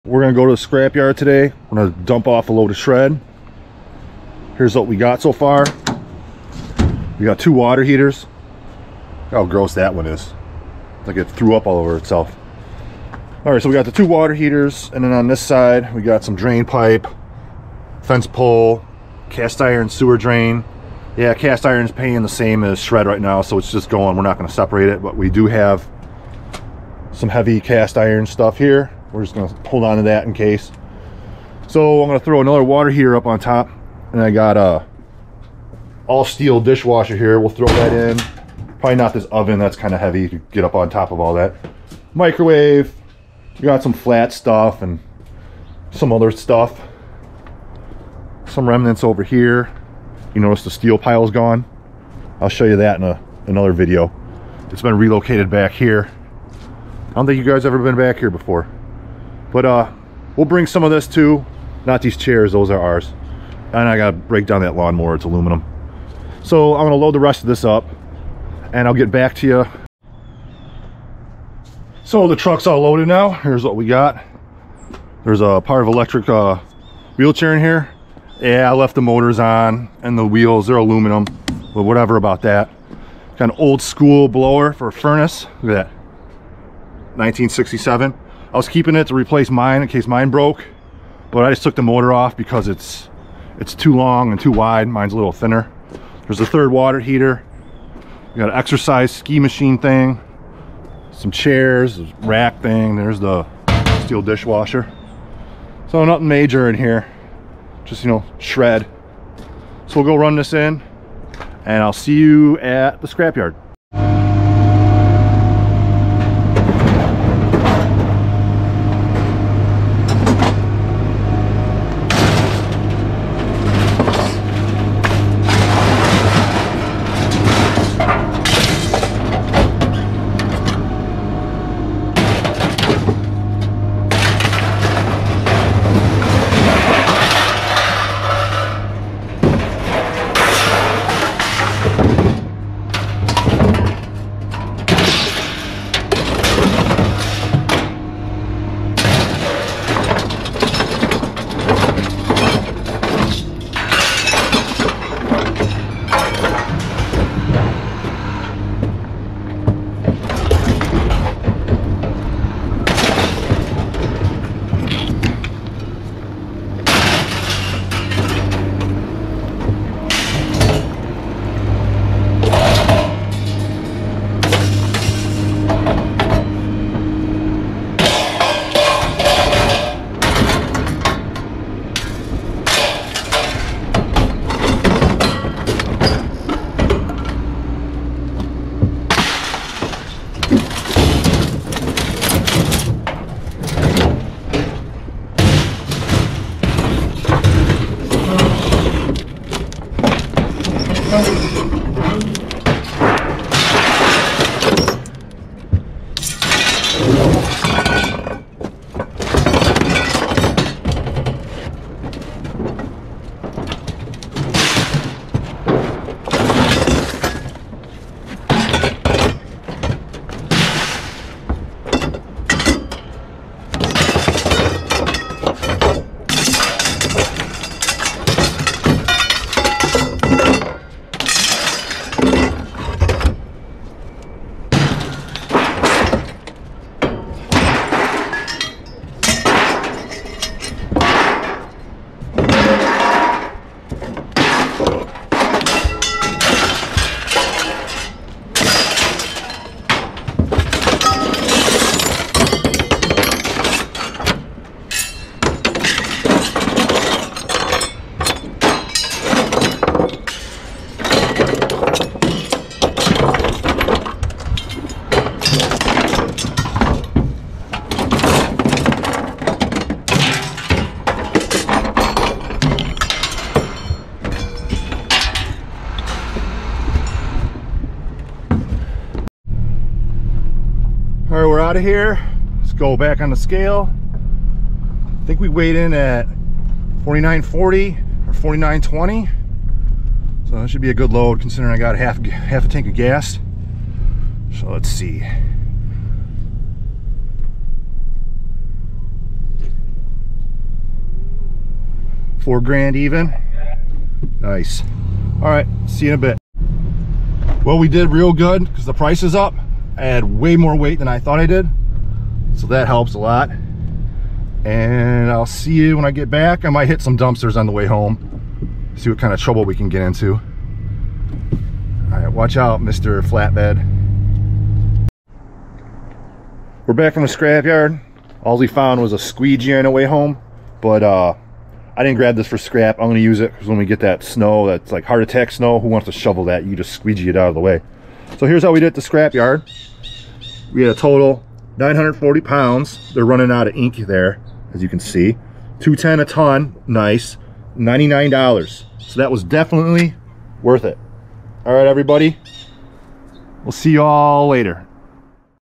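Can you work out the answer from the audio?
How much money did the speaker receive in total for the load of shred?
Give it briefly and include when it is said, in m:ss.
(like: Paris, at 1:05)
$99, at 5:47.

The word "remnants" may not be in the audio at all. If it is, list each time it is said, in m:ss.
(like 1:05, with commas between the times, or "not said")
0:48.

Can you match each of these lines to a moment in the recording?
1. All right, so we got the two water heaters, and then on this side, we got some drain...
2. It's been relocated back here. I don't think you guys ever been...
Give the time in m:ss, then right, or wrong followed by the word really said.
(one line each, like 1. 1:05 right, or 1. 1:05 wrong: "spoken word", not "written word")
1. 0:13 right
2. 0:54 right.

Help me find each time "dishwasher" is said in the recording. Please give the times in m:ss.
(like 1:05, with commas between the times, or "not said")
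0:36, 1:44.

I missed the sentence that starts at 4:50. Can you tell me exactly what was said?
So that should be a good load considering I got half, half a tank of gas.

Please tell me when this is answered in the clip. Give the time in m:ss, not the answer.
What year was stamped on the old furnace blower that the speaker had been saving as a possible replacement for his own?
1:27.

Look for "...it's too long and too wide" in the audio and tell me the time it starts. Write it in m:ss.
1:33.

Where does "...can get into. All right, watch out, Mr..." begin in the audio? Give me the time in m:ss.
5:19.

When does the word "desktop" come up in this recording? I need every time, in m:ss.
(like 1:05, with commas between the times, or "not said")
not said.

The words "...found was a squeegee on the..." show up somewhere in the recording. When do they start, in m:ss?
5:28.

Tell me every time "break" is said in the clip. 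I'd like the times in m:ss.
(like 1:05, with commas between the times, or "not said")
1:04.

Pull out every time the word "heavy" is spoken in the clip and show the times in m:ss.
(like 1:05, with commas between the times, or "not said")
0:27, 0:39.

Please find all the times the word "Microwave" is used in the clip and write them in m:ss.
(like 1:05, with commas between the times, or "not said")
0:42.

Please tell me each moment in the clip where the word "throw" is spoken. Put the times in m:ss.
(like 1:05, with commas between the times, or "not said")
0:32, 0:37.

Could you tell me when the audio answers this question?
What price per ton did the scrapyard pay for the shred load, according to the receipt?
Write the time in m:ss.
5:45.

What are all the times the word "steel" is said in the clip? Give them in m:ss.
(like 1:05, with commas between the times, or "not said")
0:36, 0:50, 1:44.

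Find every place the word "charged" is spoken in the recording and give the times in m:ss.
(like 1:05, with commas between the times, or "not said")
not said.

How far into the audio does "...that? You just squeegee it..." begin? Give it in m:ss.
5:36.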